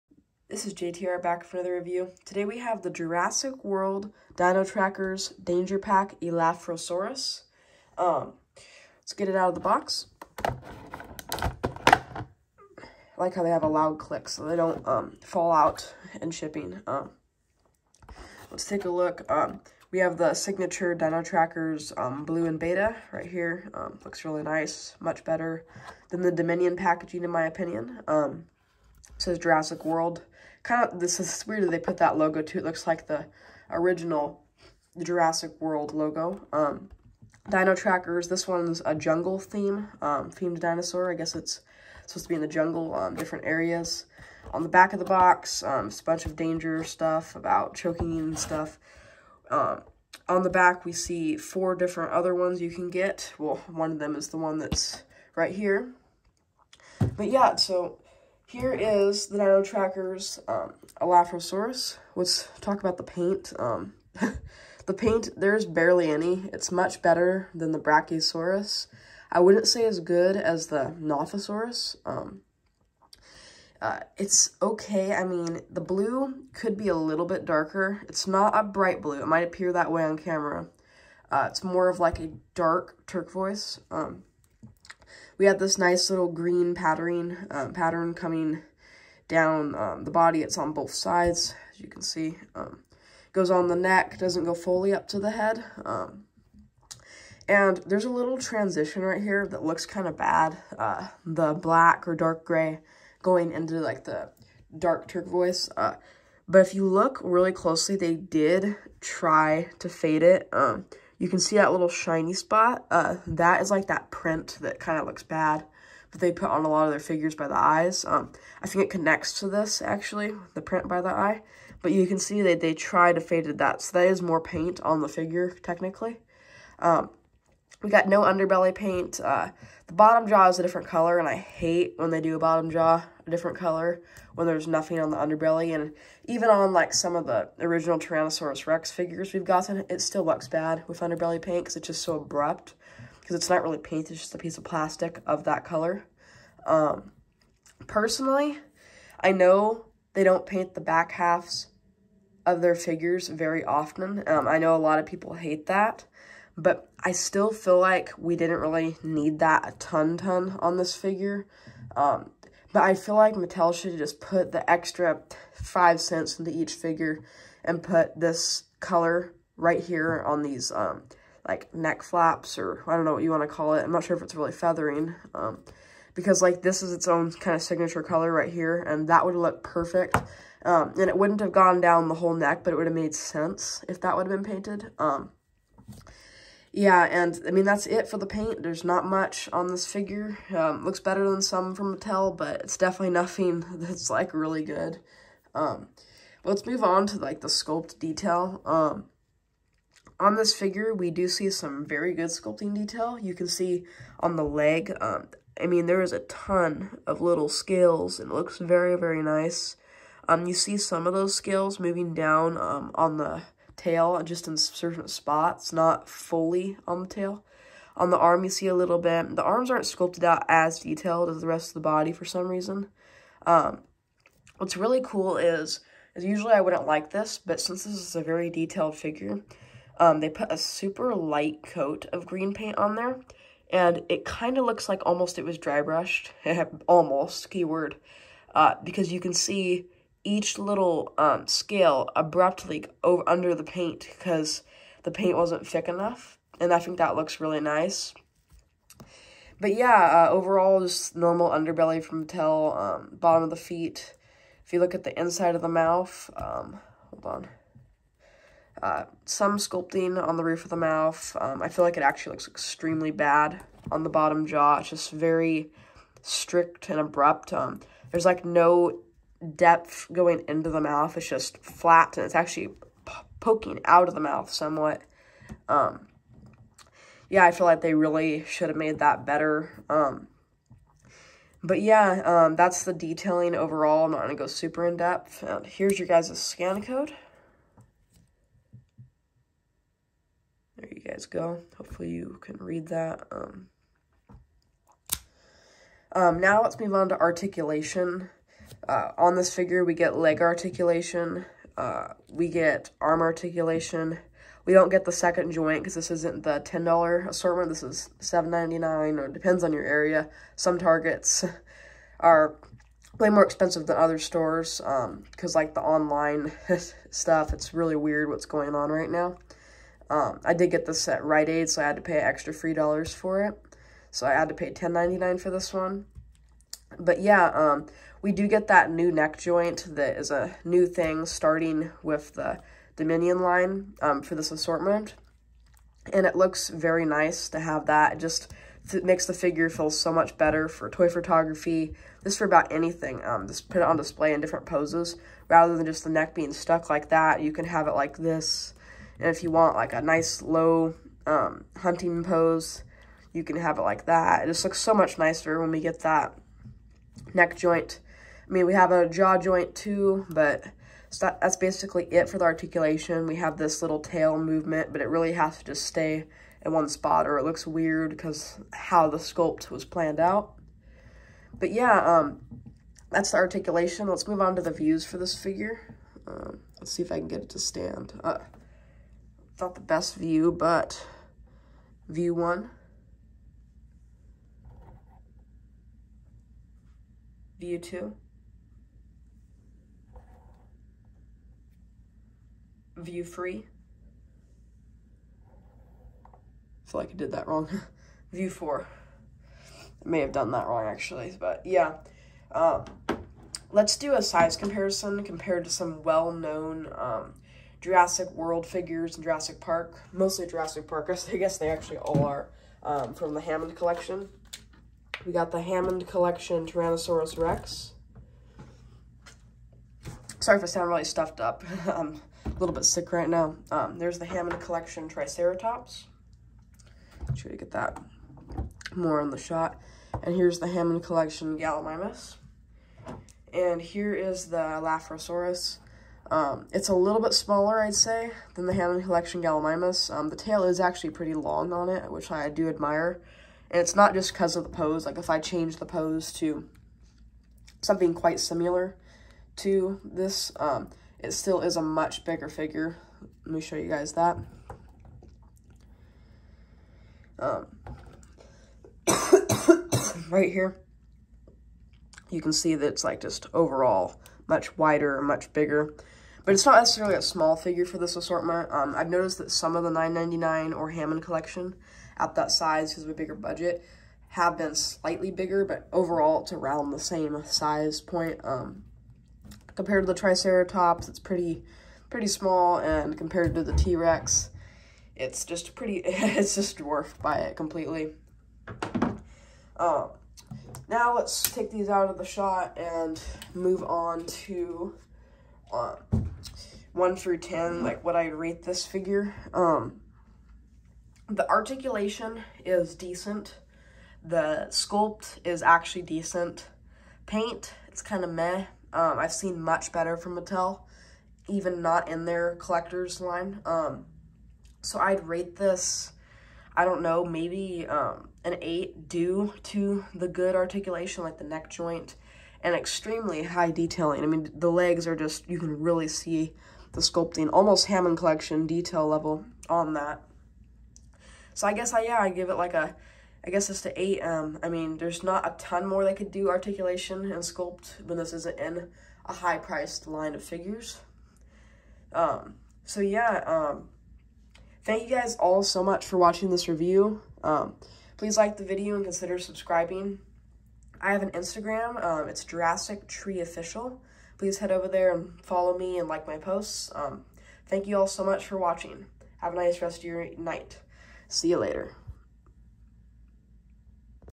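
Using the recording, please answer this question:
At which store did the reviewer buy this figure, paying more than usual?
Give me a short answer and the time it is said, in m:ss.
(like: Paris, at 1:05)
Rite Aid, at 5:21.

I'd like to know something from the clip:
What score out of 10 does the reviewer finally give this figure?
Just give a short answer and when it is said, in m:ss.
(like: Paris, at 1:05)
8, at 8:53.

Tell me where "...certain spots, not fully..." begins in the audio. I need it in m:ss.
3:34.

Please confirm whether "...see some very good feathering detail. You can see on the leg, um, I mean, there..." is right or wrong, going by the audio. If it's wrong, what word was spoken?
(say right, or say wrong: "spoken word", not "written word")
wrong: "sculpting", not "feathering".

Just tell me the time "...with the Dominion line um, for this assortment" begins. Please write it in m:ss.
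5:32.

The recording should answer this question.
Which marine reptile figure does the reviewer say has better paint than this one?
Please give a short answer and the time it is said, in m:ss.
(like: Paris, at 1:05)
Nothosaurus, at 1:11.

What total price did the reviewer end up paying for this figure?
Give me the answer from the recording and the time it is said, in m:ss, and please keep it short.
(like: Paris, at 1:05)
$10.99, at 5:24.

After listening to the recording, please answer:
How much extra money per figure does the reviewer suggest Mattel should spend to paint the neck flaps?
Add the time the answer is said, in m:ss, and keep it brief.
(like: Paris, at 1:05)
5 cents, at 2:45.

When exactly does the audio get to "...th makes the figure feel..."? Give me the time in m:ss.
5:38.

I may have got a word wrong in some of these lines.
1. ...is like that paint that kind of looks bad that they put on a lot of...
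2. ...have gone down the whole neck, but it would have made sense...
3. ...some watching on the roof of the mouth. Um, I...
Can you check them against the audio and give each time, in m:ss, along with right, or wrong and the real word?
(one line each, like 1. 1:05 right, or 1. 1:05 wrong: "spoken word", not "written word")
1. 1:53 wrong: "print", not "paint"
2. 3:01 right
3. 4:19 wrong: "sculpting", not "watching".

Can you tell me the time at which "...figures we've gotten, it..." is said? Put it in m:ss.
2:18.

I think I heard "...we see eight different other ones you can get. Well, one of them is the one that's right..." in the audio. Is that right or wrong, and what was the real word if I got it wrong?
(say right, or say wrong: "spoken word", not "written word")
wrong: "four", not "eight".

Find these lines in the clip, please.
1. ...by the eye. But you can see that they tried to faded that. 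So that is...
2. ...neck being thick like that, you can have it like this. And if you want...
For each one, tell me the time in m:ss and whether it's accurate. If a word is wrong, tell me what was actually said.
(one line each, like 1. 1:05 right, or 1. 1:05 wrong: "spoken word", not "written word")
1. 2:00 right
2. 5:46 wrong: "stuck", not "thick".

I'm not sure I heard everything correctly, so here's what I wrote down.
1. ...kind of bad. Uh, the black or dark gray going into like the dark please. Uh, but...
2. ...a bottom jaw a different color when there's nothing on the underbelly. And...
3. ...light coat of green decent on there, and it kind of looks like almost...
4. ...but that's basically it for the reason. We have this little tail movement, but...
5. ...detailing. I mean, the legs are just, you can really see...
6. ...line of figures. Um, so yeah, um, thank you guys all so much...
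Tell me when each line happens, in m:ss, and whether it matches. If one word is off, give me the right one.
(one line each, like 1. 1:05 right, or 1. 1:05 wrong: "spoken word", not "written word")
1. 1:39 wrong: "turquoise", not "please"
2. 2:12 right
3. 3:51 wrong: "paint", not "decent"
4. 6:00 wrong: "articulation", not "reason"
5. 8:43 right
6. 9:00 right.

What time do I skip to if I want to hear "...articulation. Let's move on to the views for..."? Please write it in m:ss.
6:13.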